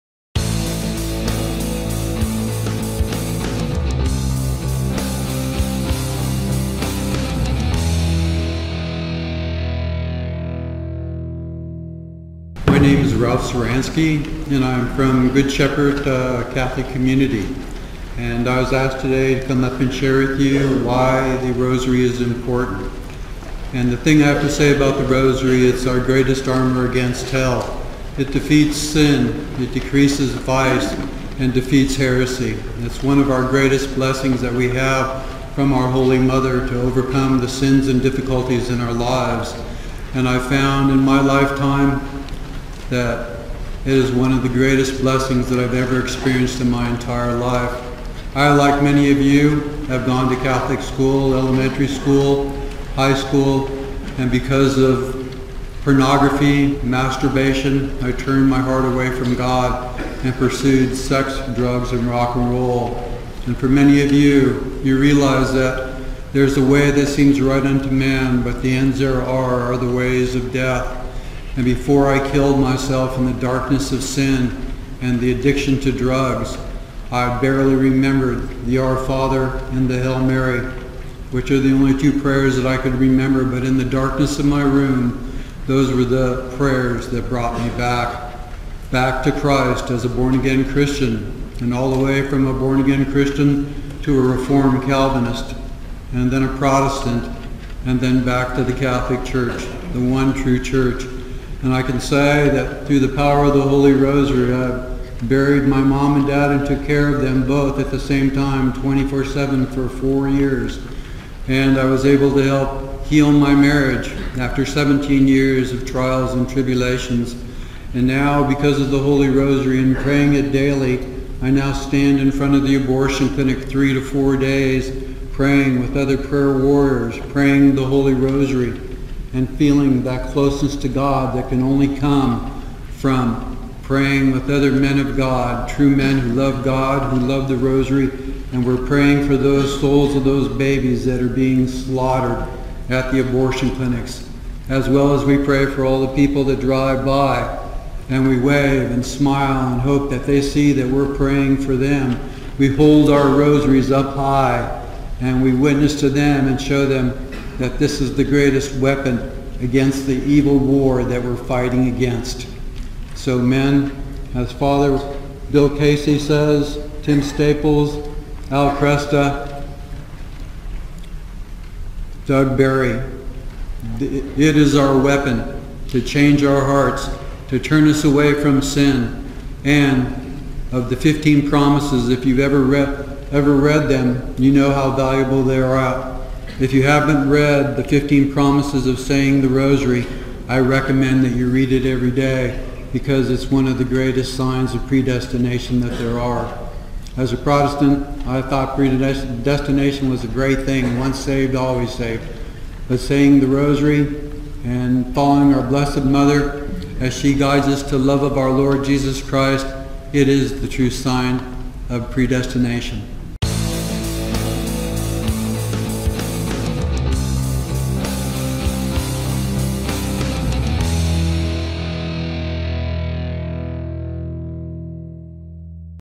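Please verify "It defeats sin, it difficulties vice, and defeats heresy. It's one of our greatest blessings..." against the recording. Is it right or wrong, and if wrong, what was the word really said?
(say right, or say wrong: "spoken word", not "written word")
wrong: "decreases", not "difficulties".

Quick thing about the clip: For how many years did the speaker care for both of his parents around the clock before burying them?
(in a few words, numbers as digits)
4.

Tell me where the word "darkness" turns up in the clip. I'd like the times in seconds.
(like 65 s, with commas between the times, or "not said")
73 s, 83 s.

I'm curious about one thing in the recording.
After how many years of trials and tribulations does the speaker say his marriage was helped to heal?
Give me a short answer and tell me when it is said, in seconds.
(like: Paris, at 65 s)
17, at 114 s.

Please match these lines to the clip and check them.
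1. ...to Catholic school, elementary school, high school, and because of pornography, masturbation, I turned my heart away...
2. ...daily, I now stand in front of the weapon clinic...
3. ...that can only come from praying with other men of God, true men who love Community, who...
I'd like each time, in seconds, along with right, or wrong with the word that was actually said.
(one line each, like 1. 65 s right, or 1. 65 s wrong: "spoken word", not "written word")
1. 50 s right
2. 120 s wrong: "abortion", not "weapon"
3. 131 s wrong: "God", not "Community".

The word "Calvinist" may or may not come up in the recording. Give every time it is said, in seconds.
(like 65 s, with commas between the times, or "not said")
94 s.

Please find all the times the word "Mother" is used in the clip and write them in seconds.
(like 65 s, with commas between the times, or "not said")
36 s, 206 s.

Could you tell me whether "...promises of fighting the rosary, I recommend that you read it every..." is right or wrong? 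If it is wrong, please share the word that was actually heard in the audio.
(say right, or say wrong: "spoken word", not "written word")
wrong: "saying", not "fighting".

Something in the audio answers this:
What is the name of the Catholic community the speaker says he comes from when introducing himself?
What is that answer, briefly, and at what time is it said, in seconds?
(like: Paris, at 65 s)
Good Shepherd, at 15 s.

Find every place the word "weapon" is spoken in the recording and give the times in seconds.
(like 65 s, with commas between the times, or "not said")
158 s, 174 s.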